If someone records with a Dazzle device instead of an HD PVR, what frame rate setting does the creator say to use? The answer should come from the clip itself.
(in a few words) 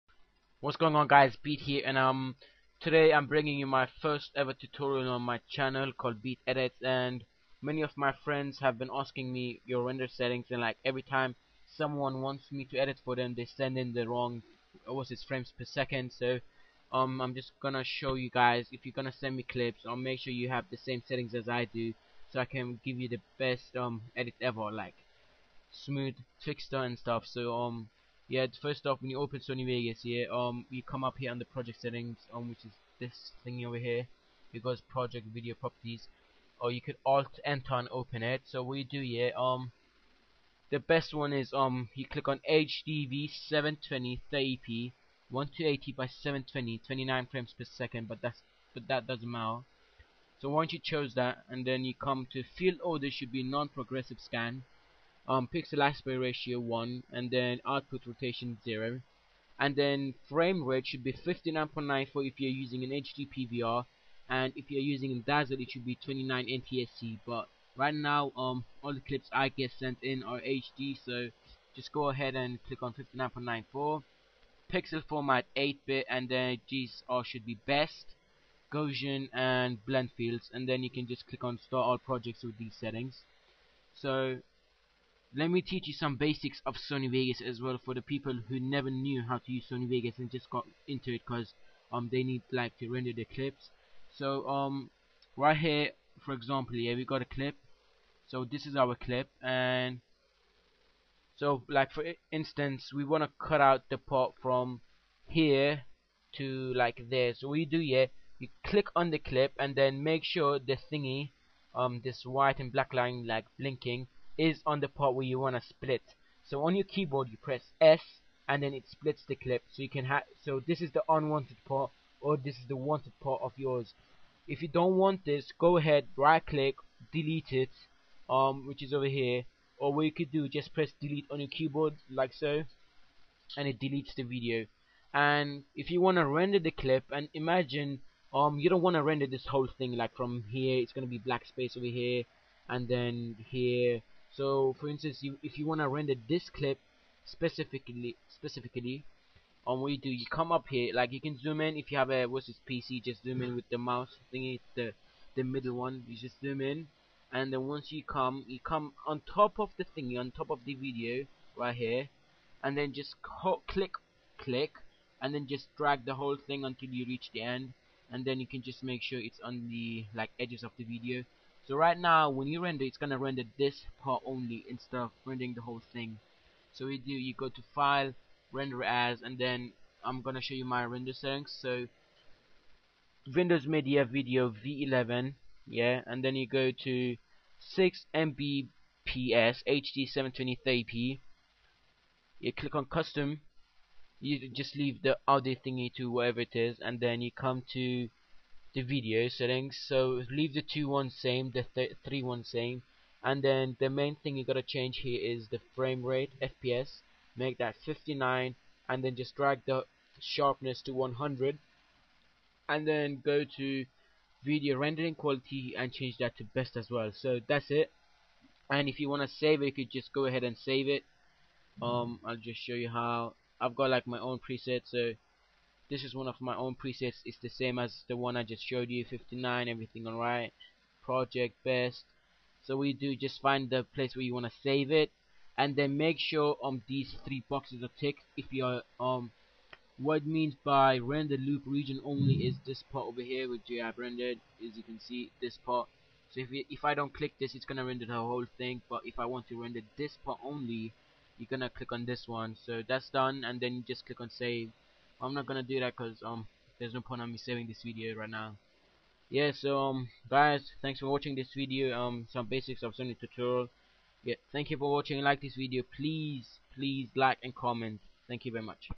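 29 NTSC.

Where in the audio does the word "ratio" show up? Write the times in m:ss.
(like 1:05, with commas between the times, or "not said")
0:56.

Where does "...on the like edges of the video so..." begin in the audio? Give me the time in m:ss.
2:49.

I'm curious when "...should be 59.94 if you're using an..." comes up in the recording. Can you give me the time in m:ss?
1:00.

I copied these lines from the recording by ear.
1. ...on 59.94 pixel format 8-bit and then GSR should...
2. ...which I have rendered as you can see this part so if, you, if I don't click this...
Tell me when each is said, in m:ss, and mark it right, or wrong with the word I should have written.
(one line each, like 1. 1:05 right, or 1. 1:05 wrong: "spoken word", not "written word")
1. 1:12 right
2. 4:03 right.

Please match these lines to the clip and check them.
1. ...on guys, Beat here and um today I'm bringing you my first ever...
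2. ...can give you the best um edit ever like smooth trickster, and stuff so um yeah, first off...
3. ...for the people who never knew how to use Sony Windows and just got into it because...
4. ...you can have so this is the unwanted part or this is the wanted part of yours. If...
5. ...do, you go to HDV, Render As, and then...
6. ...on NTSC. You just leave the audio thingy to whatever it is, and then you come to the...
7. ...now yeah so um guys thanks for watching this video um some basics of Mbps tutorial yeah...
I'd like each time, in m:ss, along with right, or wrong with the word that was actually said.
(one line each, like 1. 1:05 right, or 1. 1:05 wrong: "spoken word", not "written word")
1. 0:00 right
2. 0:22 right
3. 1:27 wrong: "Vegas", not "Windows"
4. 1:59 right
5. 2:56 wrong: "File", not "HDV"
6. 3:12 wrong: "Custom", not "NTSC"
7. 4:18 wrong: "Sony", not "Mbps".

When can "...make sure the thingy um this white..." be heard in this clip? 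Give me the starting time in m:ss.
1:50.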